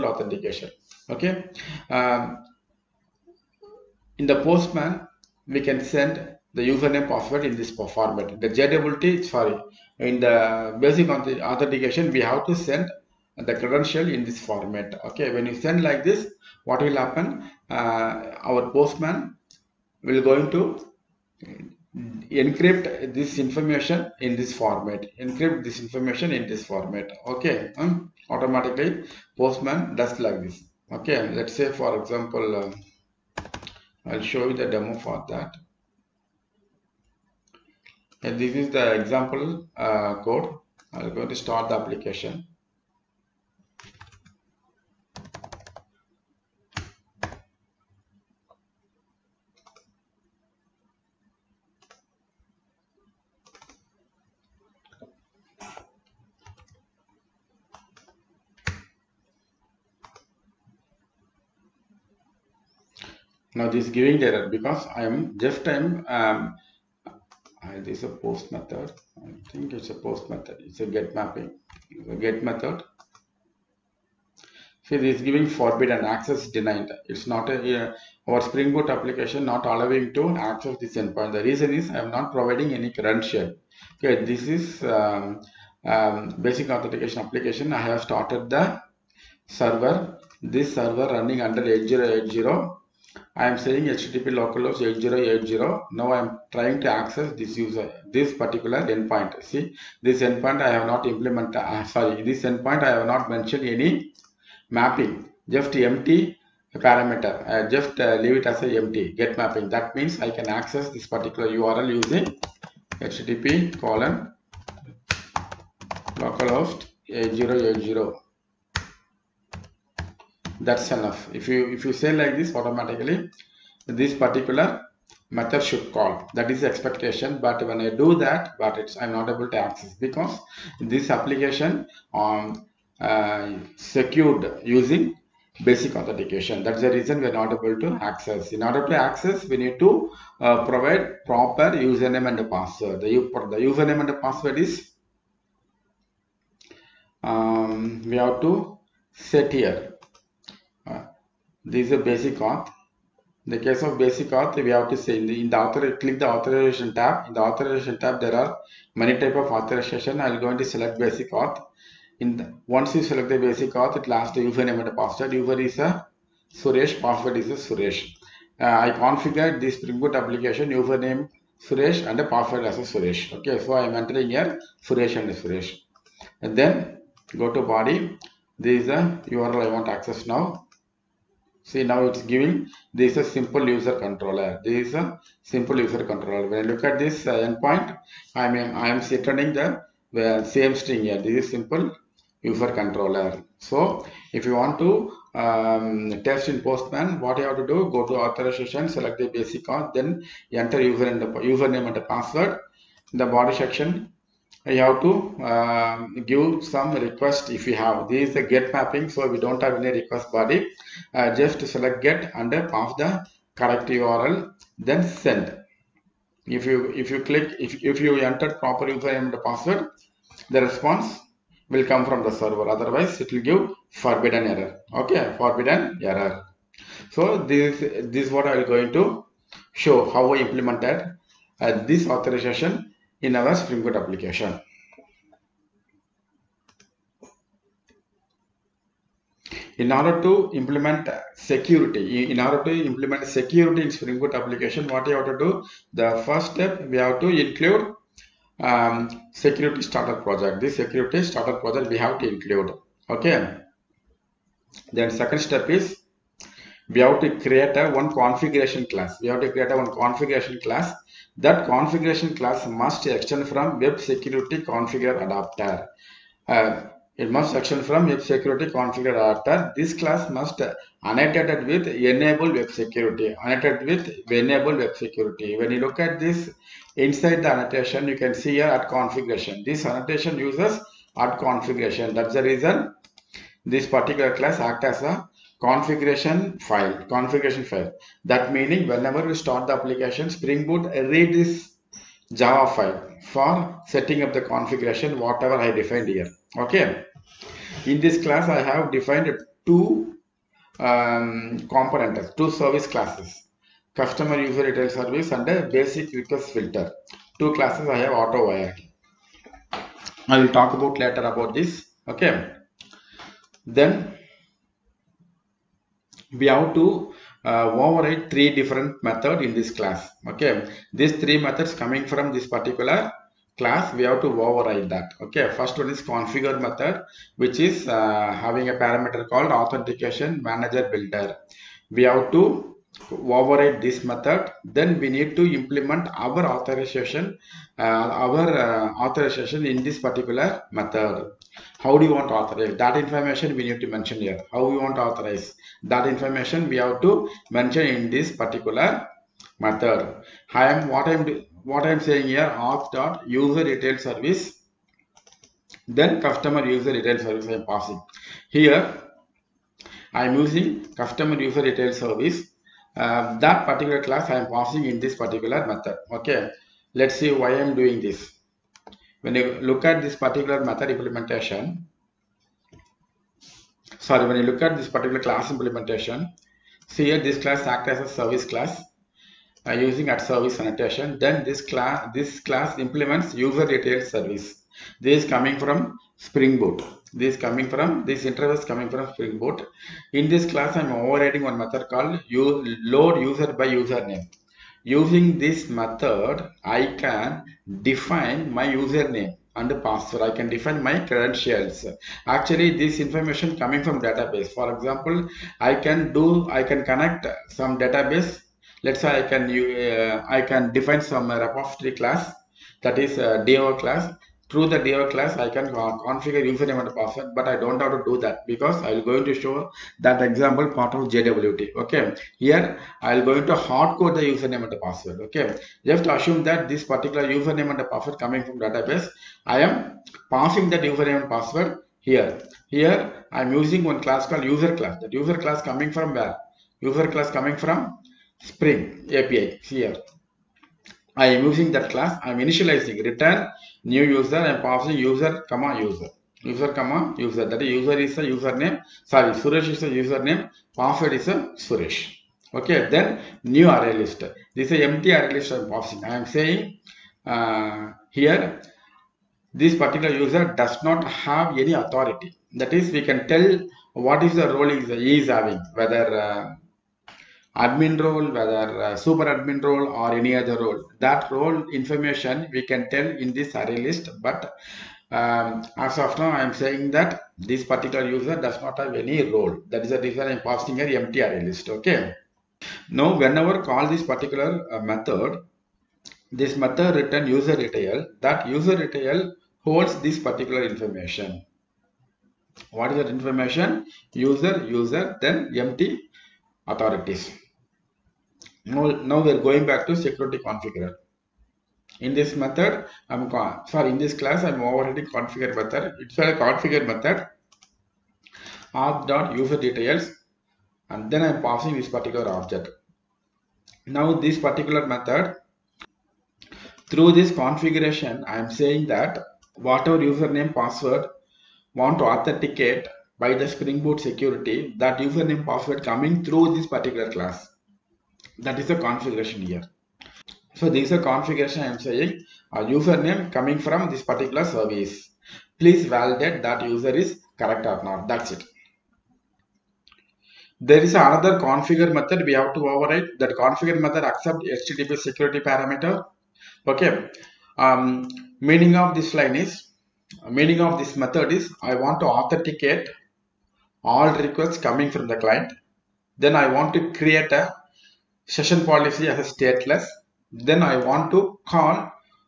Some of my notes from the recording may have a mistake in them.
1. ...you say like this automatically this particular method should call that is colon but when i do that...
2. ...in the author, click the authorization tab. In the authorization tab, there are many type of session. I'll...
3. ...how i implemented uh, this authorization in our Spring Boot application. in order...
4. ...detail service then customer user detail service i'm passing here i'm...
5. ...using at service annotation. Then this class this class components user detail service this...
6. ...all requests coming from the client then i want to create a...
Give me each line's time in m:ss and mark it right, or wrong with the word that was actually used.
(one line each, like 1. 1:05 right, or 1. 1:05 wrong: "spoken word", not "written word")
1. 2:01 wrong: "expectation", not "colon"
2. 2:35 wrong: "authorization", not "session"
3. 3:50 right
4. 5:53 right
5. 6:19 wrong: "implements", not "components"
6. 9:13 right.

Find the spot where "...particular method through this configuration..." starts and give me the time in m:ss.
8:34.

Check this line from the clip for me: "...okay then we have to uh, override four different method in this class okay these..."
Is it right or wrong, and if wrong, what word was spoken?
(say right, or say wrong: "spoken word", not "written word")
wrong: "three", not "four".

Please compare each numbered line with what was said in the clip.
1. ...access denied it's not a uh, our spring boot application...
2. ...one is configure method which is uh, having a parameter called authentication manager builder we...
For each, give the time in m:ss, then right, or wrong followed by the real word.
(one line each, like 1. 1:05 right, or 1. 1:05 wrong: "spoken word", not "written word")
1. 1:16 right
2. 5:25 right.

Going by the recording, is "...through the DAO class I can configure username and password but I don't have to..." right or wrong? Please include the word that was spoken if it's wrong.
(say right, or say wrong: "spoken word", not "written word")
right.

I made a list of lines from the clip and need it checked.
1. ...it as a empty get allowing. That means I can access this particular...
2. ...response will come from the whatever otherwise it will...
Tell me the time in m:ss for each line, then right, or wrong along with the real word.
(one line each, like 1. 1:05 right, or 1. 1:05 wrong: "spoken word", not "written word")
1. 1:48 wrong: "mapping", not "allowing"
2. 3:40 wrong: "server", not "whatever".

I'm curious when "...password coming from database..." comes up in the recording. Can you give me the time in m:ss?
7:07.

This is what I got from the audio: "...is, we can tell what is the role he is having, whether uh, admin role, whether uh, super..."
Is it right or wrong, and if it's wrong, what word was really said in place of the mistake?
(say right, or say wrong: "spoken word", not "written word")
right.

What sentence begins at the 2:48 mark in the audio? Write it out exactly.
Uh, I configured this Spring Boot application username Suresh and the password as a Suresh.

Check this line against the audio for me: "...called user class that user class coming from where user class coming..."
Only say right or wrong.
right.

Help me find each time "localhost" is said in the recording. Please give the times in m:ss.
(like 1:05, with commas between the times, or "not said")
1:34, 1:56.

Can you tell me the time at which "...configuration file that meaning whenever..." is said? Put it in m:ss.
4:47.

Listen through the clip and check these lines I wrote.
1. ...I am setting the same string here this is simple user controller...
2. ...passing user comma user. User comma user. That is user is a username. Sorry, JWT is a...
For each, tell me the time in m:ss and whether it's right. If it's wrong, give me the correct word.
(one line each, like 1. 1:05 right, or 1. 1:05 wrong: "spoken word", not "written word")
1. 3:08 right
2. 7:24 wrong: "Suresh", not "JWT".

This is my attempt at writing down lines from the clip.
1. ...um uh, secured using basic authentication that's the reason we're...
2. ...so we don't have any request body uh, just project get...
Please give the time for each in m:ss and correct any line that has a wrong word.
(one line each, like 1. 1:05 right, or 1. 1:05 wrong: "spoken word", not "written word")
1. 2:12 right
2. 3:29 wrong: "select", not "project".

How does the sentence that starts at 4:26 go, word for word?
Uh, it must extend from web security configure adapter.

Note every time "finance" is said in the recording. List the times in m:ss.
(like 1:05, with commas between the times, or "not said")
not said.